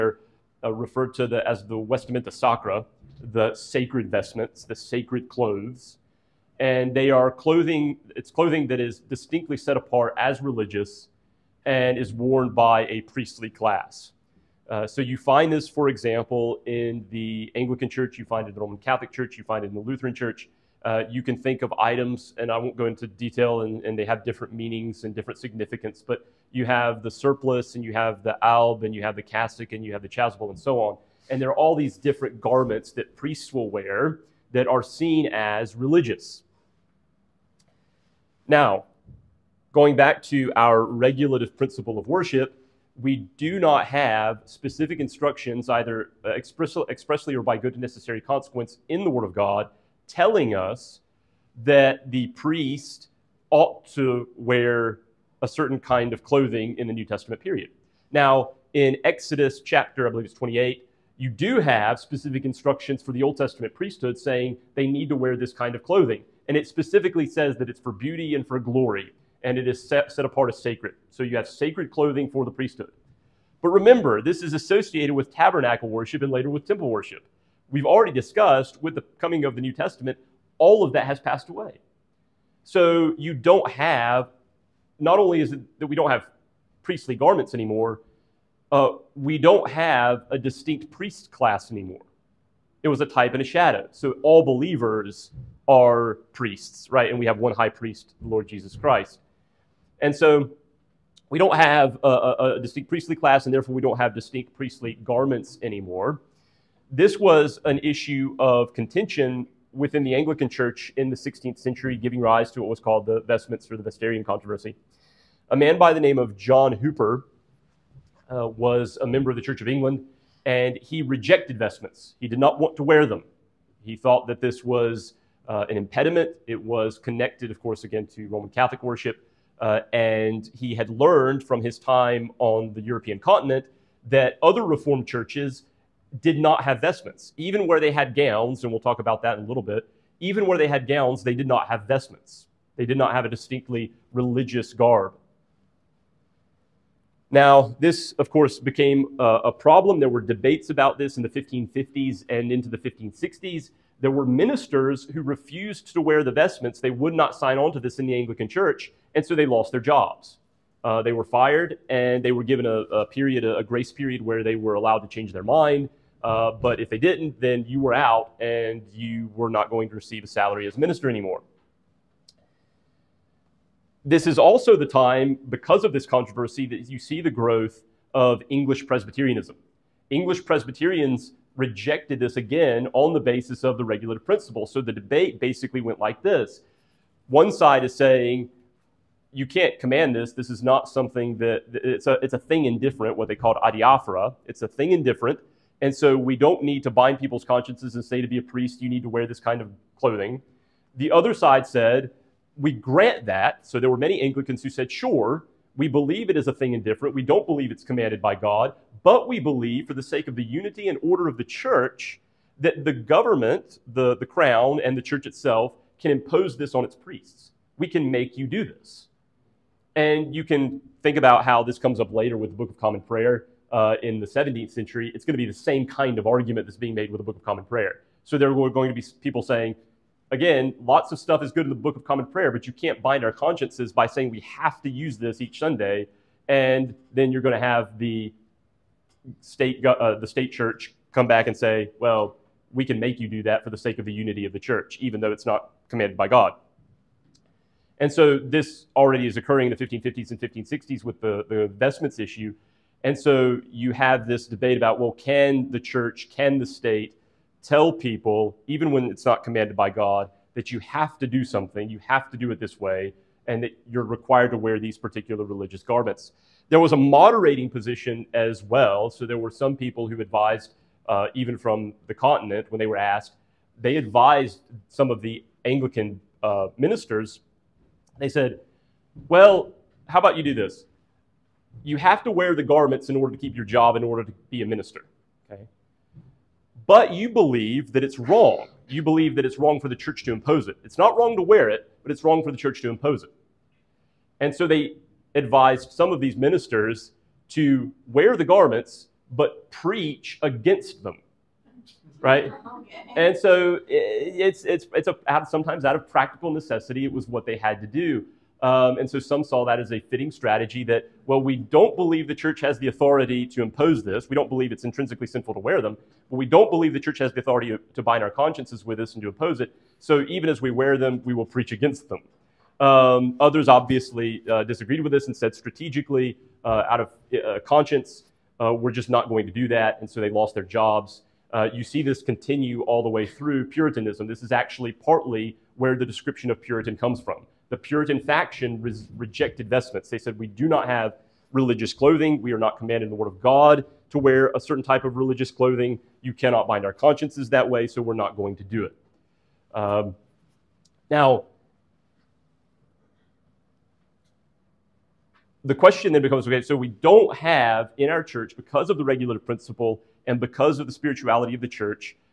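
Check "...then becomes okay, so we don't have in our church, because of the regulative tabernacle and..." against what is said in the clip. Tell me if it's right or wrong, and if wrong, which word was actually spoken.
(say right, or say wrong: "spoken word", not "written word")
wrong: "principle", not "tabernacle".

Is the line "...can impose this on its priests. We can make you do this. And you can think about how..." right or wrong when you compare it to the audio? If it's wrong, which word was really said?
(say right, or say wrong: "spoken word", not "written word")
right.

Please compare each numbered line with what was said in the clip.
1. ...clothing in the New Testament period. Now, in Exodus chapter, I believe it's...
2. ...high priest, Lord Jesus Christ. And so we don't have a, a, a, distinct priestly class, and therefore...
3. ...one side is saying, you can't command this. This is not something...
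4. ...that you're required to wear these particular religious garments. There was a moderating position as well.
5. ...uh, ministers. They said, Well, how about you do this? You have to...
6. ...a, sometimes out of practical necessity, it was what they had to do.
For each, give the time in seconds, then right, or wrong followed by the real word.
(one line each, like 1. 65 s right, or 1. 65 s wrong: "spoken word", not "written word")
1. 56 s right
2. 97 s right
3. 187 s right
4. 263 s right
5. 276 s right
6. 305 s right.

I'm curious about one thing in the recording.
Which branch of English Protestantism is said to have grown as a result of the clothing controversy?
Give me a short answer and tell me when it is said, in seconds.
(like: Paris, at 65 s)
English Presbyterianism, at 178 s.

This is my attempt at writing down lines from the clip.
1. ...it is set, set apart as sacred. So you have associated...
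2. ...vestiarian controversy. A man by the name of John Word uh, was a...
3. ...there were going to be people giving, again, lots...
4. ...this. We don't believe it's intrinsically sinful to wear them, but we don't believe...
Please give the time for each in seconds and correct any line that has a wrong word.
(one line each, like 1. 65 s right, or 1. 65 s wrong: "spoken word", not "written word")
1. 69 s wrong: "sacred", not "associated"
2. 113 s wrong: "Hooper", not "Word"
3. 228 s wrong: "saying", not "giving"
4. 314 s right.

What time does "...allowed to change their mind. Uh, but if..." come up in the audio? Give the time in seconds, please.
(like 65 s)
164 s.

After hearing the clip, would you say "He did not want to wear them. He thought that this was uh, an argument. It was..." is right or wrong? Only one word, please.
wrong.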